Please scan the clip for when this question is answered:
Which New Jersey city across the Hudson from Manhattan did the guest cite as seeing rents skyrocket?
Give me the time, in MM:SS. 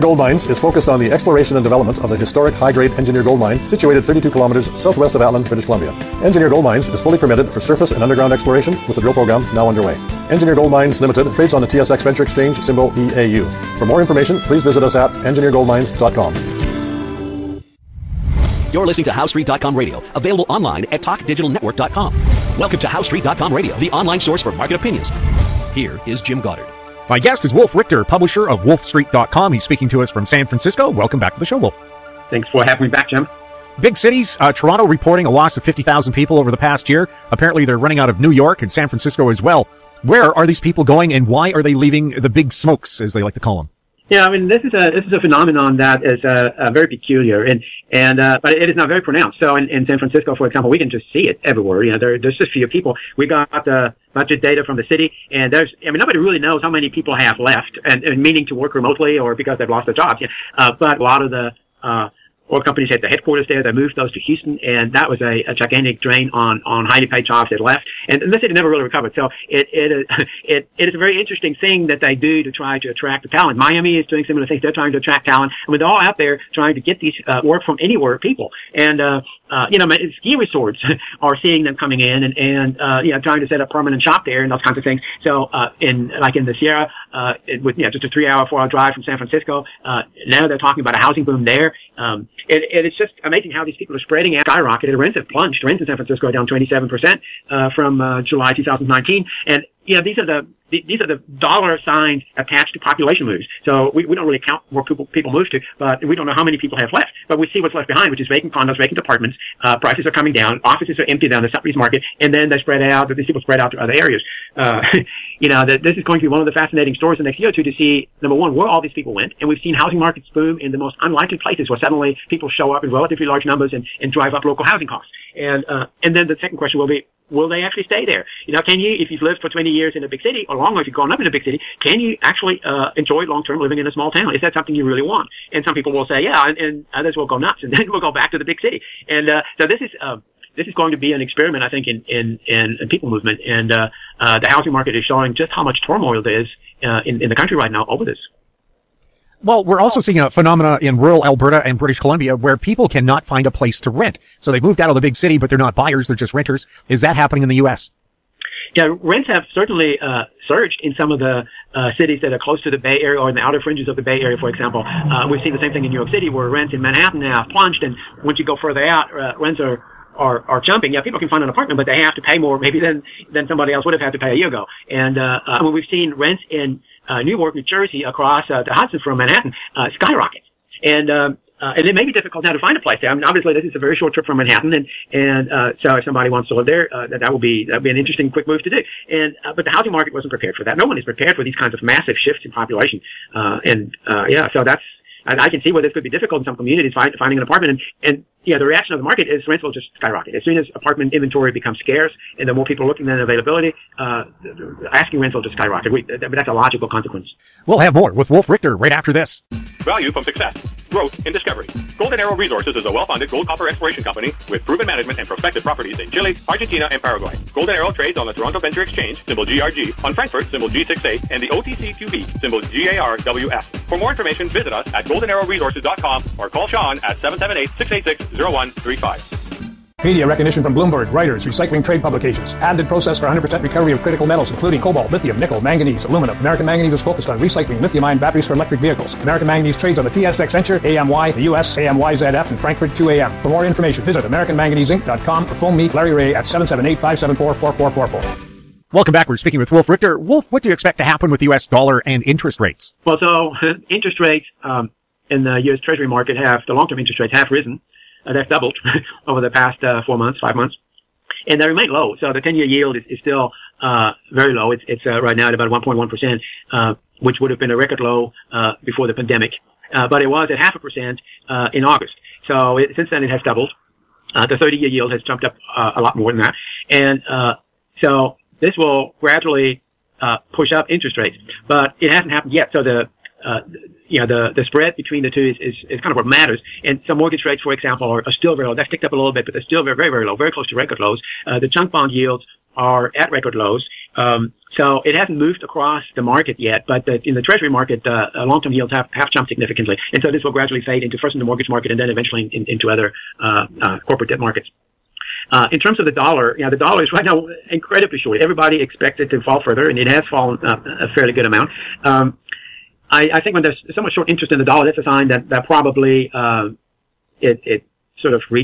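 02:57.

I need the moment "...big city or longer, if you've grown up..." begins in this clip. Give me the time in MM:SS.
02:10.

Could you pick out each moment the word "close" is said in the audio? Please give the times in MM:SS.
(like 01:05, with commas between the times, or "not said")
02:42, 04:50.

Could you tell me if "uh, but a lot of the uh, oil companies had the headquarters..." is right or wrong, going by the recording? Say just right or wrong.
right.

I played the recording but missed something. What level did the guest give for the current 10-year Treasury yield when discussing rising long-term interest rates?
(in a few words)
1.1%.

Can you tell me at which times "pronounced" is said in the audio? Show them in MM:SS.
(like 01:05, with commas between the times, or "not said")
00:48.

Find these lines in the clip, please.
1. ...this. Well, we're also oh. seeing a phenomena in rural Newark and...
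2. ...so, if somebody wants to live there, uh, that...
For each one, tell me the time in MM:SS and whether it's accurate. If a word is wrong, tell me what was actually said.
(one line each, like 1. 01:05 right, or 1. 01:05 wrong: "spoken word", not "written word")
1. 02:28 wrong: "Alberta", not "Newark"
2. 03:05 right.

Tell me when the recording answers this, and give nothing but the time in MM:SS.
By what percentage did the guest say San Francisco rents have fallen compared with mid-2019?
01:36.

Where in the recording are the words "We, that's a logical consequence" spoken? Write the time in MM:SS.
03:25.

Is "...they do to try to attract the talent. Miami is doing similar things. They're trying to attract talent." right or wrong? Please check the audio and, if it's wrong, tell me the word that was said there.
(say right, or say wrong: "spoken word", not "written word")
right.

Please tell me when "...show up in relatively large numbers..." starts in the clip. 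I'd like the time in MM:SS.
02:02.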